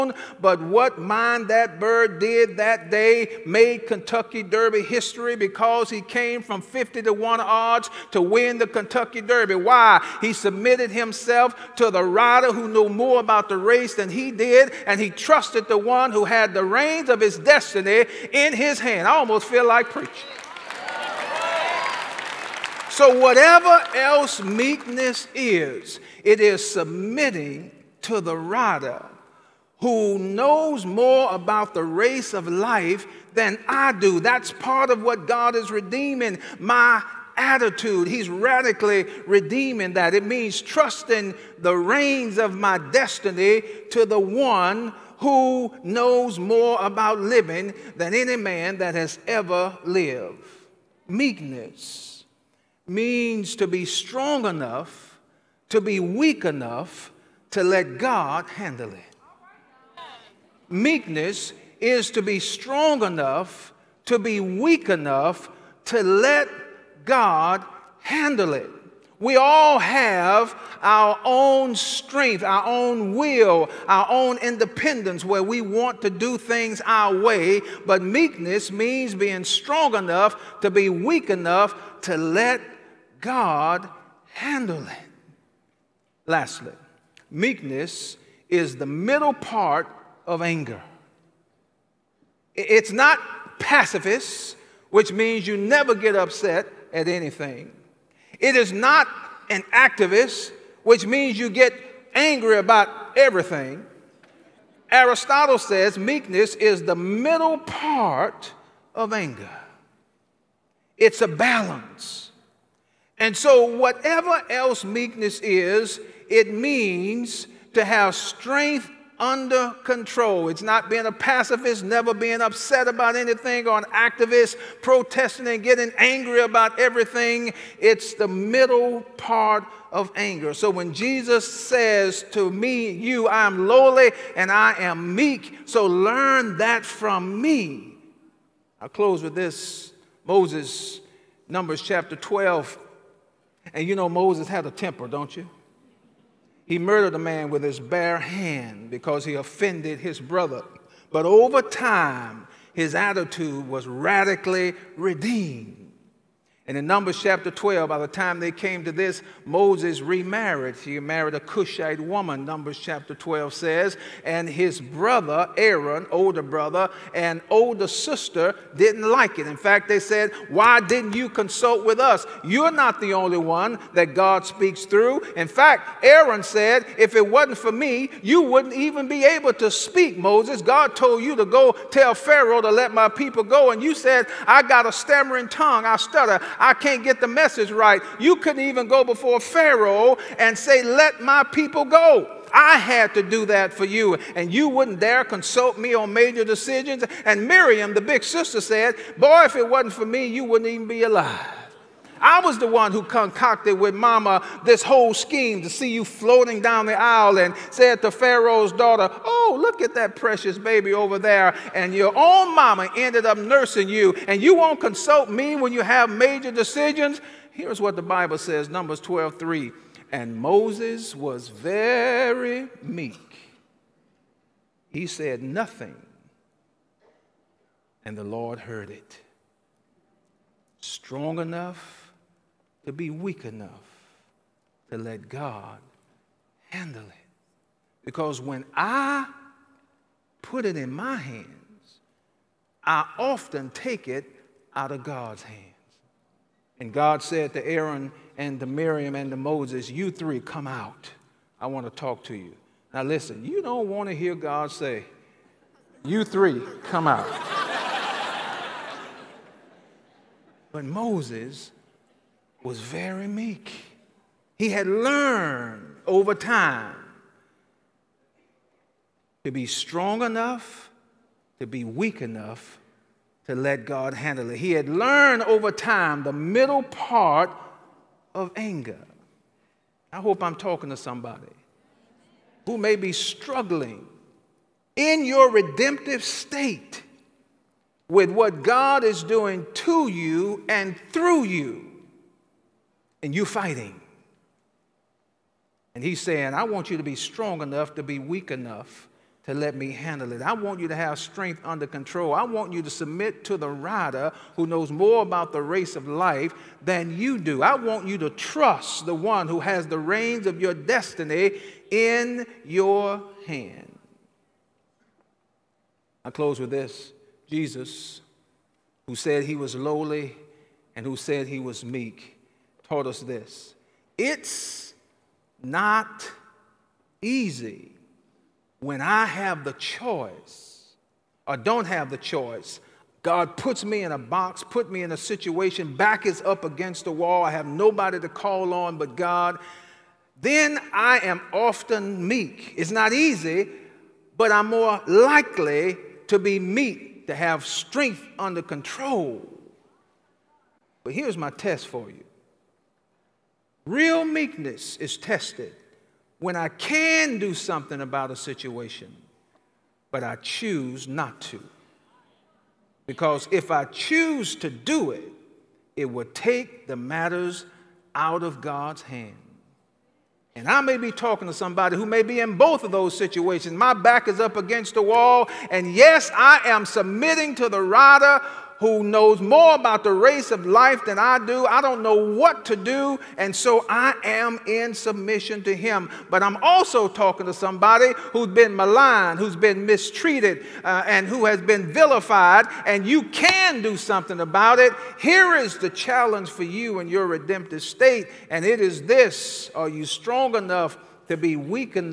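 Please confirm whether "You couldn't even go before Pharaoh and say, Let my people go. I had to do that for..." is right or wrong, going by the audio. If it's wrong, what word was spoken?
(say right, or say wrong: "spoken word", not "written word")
right.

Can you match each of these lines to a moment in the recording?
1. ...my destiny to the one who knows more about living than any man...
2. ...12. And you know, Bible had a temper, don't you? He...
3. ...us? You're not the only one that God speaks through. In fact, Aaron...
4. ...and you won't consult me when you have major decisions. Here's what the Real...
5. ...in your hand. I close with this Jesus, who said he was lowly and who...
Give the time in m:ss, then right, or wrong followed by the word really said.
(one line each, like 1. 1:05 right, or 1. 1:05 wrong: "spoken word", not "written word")
1. 0:42 right
2. 2:22 wrong: "Moses", not "Bible"
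3. 2:51 right
4. 3:34 wrong: "Bible", not "Real"
5. 5:11 right.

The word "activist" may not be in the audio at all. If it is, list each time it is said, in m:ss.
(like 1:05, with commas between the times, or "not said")
1:39, 2:03.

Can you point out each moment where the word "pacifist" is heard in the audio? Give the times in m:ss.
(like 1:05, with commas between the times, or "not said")
1:33, 2:01.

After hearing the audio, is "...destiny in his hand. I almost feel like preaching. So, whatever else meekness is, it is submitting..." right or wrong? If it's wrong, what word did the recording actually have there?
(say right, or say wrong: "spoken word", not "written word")
right.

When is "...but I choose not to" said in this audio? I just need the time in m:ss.
6:00.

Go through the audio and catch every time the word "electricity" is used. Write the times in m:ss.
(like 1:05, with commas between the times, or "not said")
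not said.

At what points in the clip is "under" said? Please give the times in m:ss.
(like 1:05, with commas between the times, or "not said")
1:59, 5:01, 5:48.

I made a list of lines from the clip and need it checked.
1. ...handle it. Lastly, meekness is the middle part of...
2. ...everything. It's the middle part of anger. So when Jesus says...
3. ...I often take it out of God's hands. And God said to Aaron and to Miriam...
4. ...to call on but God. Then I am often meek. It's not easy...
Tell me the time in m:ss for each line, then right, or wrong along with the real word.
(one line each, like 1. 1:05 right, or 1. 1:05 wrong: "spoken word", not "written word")
1. 1:24 right
2. 2:06 right
3. 4:02 right
4. 5:38 right.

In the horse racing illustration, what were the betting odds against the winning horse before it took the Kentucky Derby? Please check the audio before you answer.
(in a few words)
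50 to 1.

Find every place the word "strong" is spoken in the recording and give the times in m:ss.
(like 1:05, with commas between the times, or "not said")
0:53, 1:02, 1:19, 3:50, 4:29, 4:57, 6:40.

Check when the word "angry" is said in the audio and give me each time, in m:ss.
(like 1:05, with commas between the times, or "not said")
1:42, 2:05.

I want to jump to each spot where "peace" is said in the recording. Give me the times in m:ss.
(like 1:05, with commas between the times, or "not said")
not said.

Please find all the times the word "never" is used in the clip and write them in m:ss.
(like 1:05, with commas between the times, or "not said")
1:35, 2:01.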